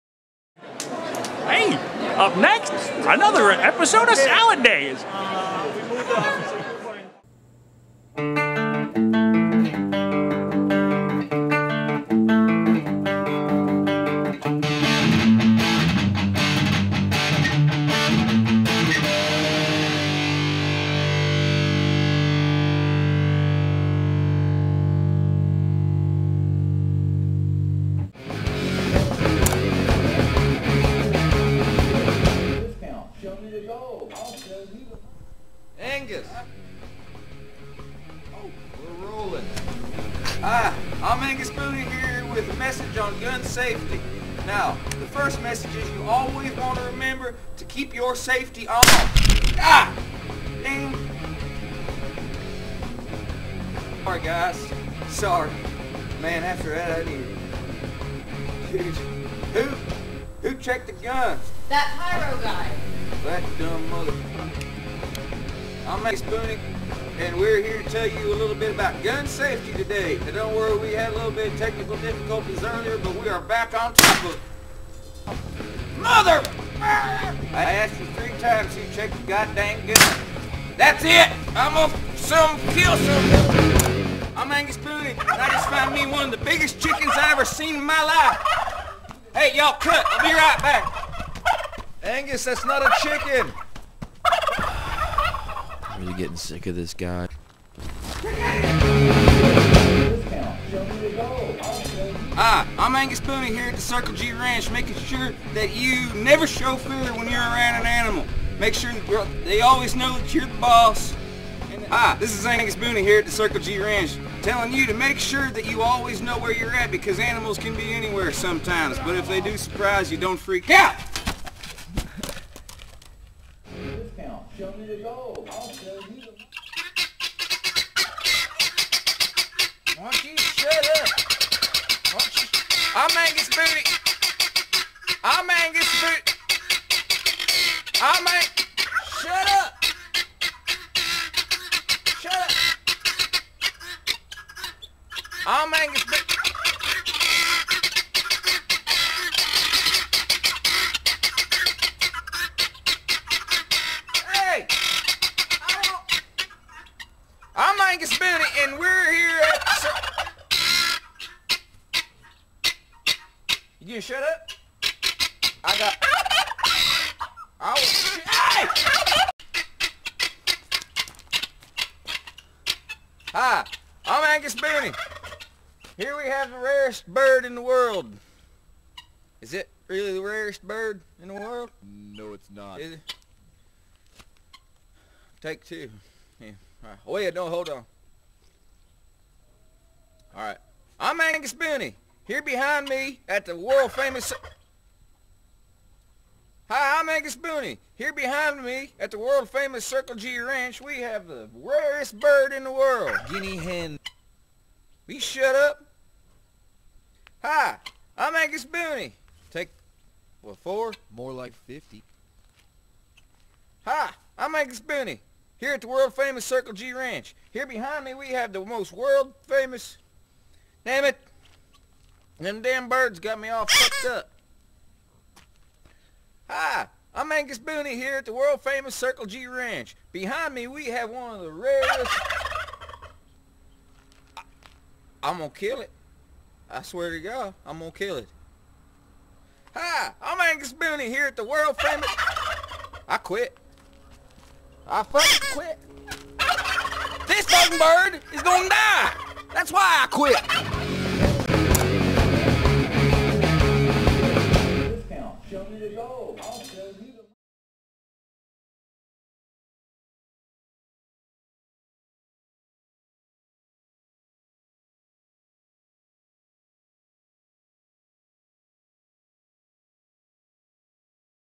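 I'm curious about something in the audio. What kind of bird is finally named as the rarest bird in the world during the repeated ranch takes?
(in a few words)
Guinea hen.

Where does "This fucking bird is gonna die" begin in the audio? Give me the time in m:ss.
4:07.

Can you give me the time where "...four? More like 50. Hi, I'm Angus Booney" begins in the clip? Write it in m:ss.
3:30.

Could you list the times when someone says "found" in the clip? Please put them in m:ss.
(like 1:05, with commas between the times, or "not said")
1:25.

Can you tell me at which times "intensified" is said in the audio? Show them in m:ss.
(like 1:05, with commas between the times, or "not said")
not said.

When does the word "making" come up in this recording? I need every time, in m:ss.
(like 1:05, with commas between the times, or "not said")
1:44.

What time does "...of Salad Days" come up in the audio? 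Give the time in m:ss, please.
0:04.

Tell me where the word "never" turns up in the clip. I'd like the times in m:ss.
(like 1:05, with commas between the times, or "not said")
1:46.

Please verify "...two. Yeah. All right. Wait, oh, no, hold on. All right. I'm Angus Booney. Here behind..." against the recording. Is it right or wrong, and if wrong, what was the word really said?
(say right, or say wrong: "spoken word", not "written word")
right.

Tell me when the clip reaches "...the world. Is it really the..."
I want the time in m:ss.
2:57.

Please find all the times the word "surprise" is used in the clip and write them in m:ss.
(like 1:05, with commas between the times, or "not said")
1:59.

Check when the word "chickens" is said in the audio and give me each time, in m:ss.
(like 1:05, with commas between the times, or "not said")
1:26, 1:33.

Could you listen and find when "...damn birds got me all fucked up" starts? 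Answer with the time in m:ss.
3:42.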